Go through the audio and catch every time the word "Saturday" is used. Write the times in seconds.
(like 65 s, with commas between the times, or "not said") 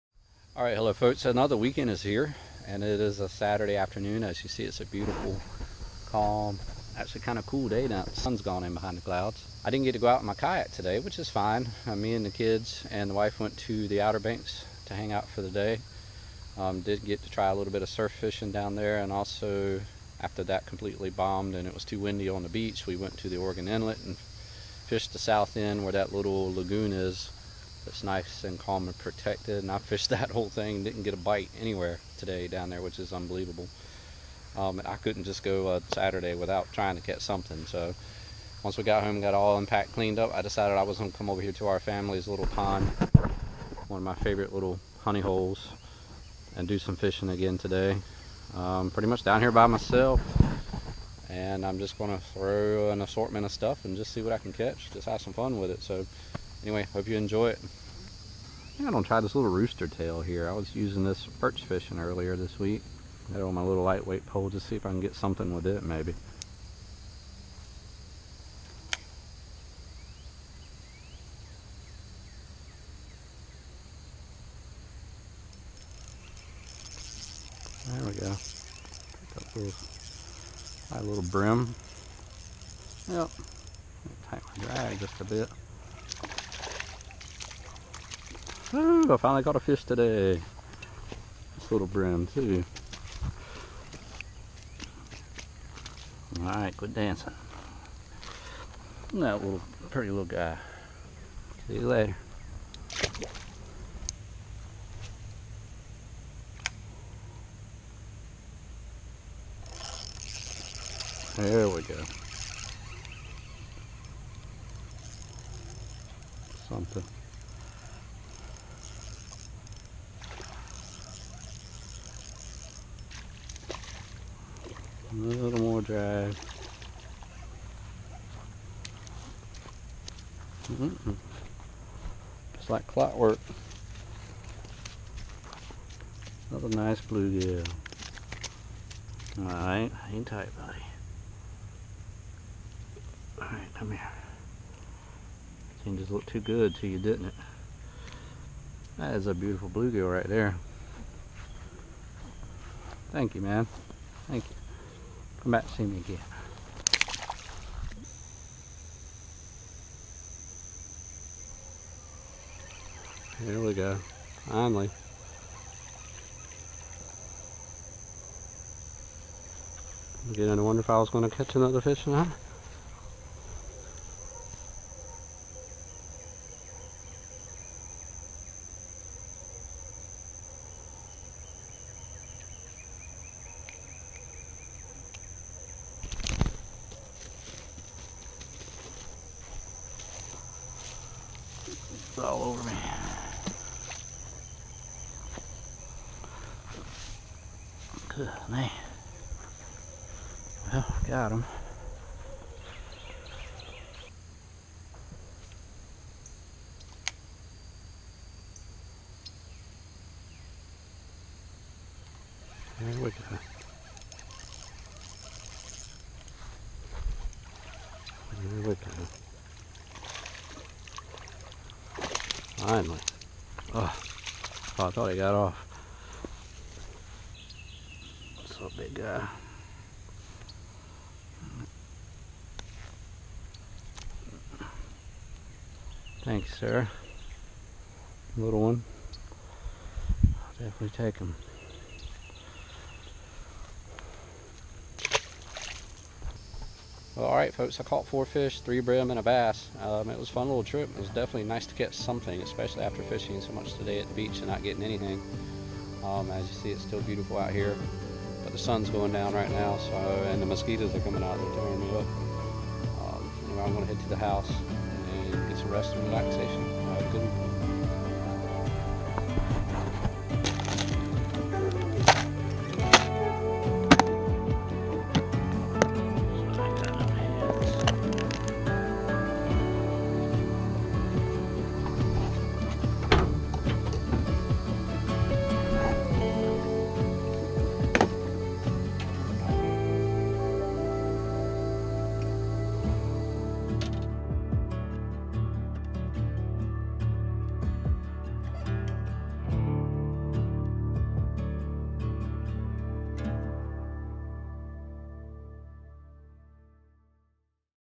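3 s, 35 s.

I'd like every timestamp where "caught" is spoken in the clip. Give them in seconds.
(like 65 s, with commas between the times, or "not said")
89 s, 247 s.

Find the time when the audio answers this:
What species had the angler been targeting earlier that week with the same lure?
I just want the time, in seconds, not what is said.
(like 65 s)
61 s.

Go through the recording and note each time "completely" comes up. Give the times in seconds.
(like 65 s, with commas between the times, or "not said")
20 s.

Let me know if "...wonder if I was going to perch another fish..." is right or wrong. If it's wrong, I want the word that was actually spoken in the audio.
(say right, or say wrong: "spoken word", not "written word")
wrong: "catch", not "perch".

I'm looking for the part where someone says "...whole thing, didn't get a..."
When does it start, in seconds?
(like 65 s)
30 s.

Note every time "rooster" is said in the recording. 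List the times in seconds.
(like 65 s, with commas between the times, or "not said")
59 s.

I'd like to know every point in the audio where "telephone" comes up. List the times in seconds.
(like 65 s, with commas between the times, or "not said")
not said.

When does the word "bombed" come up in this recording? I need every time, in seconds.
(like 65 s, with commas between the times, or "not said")
21 s.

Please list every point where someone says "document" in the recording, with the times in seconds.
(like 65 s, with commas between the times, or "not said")
not said.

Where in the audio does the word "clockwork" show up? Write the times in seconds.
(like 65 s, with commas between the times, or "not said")
132 s.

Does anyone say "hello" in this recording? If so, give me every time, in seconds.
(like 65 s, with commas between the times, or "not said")
0 s.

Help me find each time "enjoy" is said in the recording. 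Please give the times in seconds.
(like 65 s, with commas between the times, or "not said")
57 s.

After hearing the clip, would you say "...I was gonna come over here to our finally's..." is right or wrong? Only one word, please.
wrong.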